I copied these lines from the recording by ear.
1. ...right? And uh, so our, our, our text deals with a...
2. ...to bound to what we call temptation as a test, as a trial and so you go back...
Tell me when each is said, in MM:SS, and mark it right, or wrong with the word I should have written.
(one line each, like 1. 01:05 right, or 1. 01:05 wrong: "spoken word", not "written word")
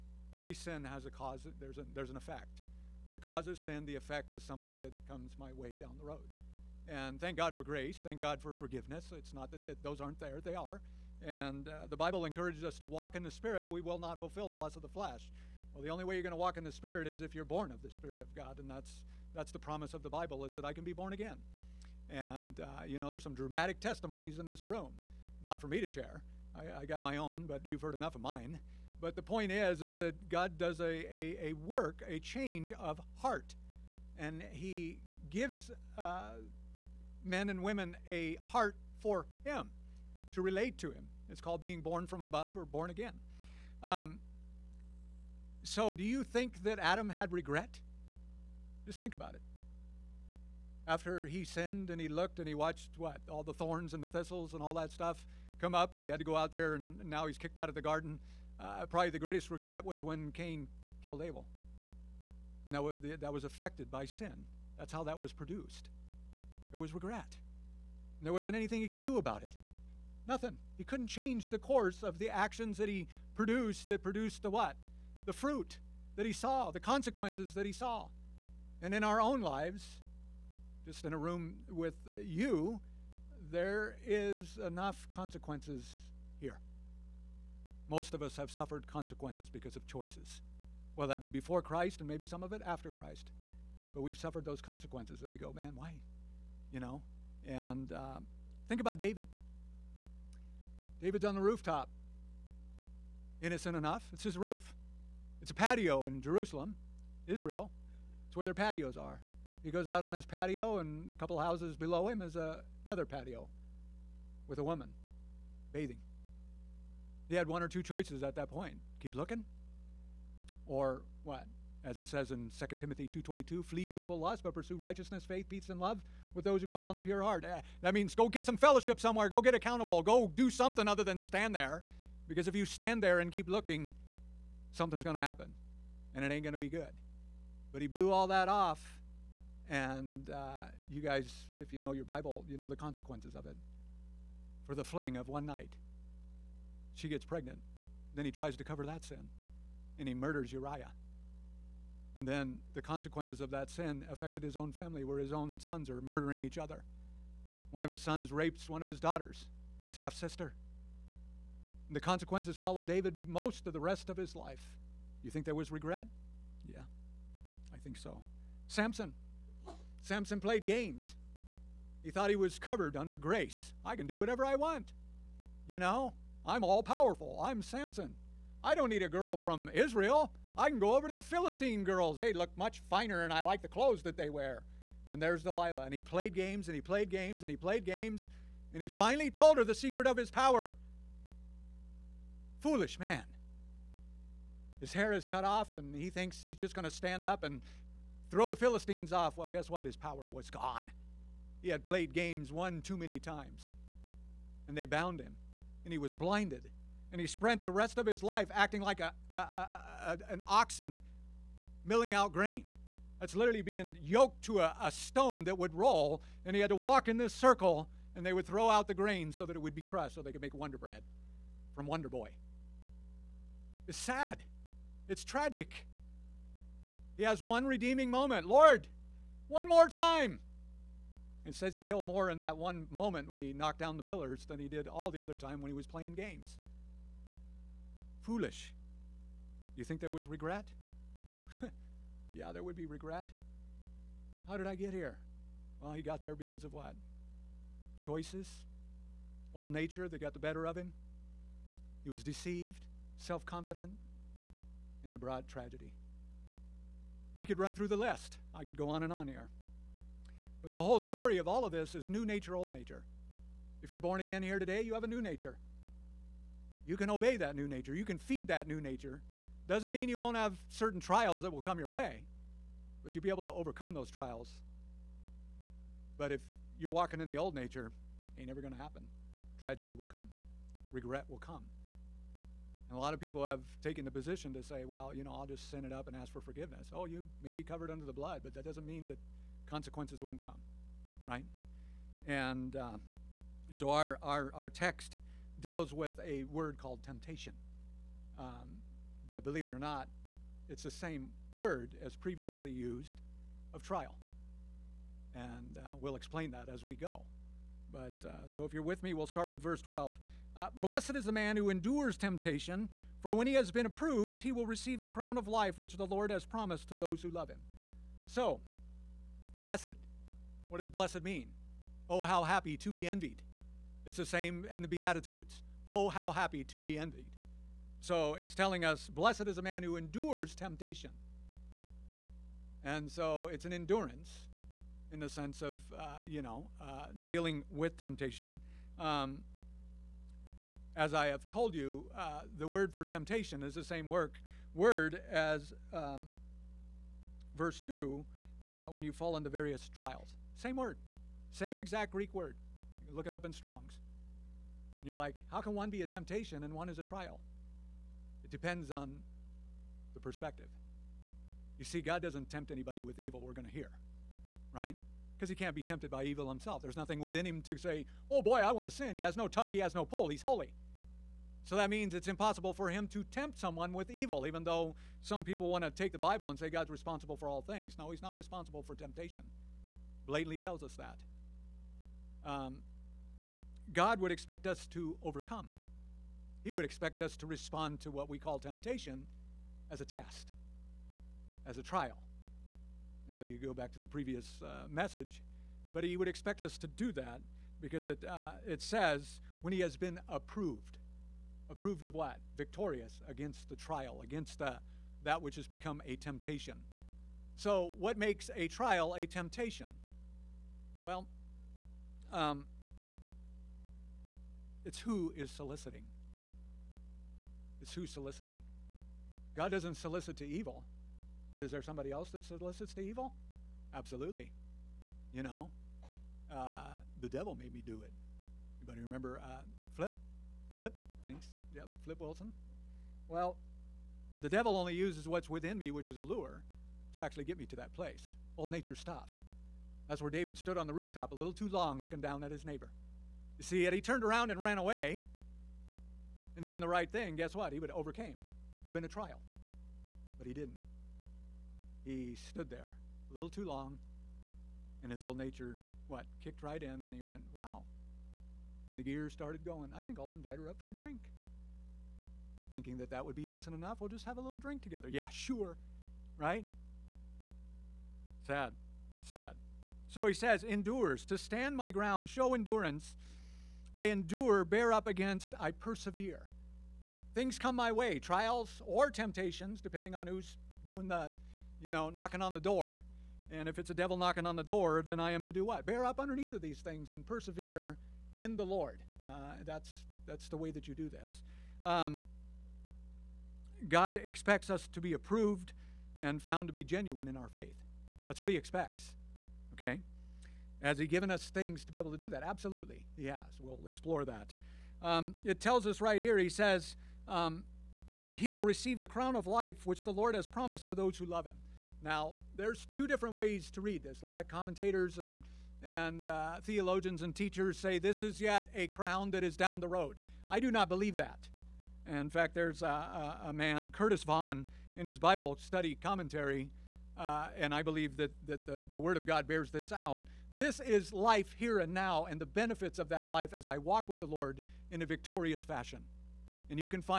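1. 04:51 right
2. 06:27 wrong: "respond", not "bound".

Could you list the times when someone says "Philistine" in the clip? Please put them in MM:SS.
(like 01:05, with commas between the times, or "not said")
03:01, 03:18.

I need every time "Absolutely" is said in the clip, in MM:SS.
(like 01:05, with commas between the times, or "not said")
07:03, 08:22.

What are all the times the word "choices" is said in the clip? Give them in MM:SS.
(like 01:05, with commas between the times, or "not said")
01:29, 01:57, 04:08.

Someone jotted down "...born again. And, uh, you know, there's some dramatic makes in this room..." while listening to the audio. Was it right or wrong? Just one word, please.
wrong.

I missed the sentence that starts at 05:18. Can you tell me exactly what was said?
So, blessed what does blessed mean?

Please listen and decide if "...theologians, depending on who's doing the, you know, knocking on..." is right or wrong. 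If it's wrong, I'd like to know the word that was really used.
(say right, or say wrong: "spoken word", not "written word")
wrong: "temptations", not "theologians".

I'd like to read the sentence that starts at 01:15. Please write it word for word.
The fruit that he saw, the consequences that he saw.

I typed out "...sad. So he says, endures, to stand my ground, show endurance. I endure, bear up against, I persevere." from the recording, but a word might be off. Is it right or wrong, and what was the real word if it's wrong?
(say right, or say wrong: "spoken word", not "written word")
right.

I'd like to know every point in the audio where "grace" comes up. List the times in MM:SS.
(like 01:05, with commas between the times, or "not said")
00:07, 02:53.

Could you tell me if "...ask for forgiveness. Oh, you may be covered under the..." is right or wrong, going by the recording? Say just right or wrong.
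right.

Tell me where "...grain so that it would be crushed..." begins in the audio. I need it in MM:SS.
03:38.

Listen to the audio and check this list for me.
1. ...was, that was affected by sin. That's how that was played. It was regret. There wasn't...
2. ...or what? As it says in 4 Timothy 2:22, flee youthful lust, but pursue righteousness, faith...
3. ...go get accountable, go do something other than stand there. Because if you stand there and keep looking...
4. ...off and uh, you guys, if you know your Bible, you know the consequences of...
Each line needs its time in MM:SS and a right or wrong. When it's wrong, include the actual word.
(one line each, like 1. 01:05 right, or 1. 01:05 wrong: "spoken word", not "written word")
1. 01:02 wrong: "produced", not "played"
2. 02:00 wrong: "2", not "4"
3. 02:09 right
4. 02:18 right.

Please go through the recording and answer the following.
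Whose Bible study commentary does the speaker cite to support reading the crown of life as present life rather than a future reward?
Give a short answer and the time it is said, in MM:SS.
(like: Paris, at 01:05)
Curtis Vaughan, at 08:43.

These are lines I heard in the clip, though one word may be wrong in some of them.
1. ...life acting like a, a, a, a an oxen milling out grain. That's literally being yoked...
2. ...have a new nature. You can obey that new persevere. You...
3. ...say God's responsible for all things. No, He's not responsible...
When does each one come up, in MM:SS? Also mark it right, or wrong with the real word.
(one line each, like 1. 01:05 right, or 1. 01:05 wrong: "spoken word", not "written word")
1. 03:28 right
2. 04:24 wrong: "nature", not "persevere"
3. 06:16 right.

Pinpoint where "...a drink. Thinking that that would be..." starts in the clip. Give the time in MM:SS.
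07:40.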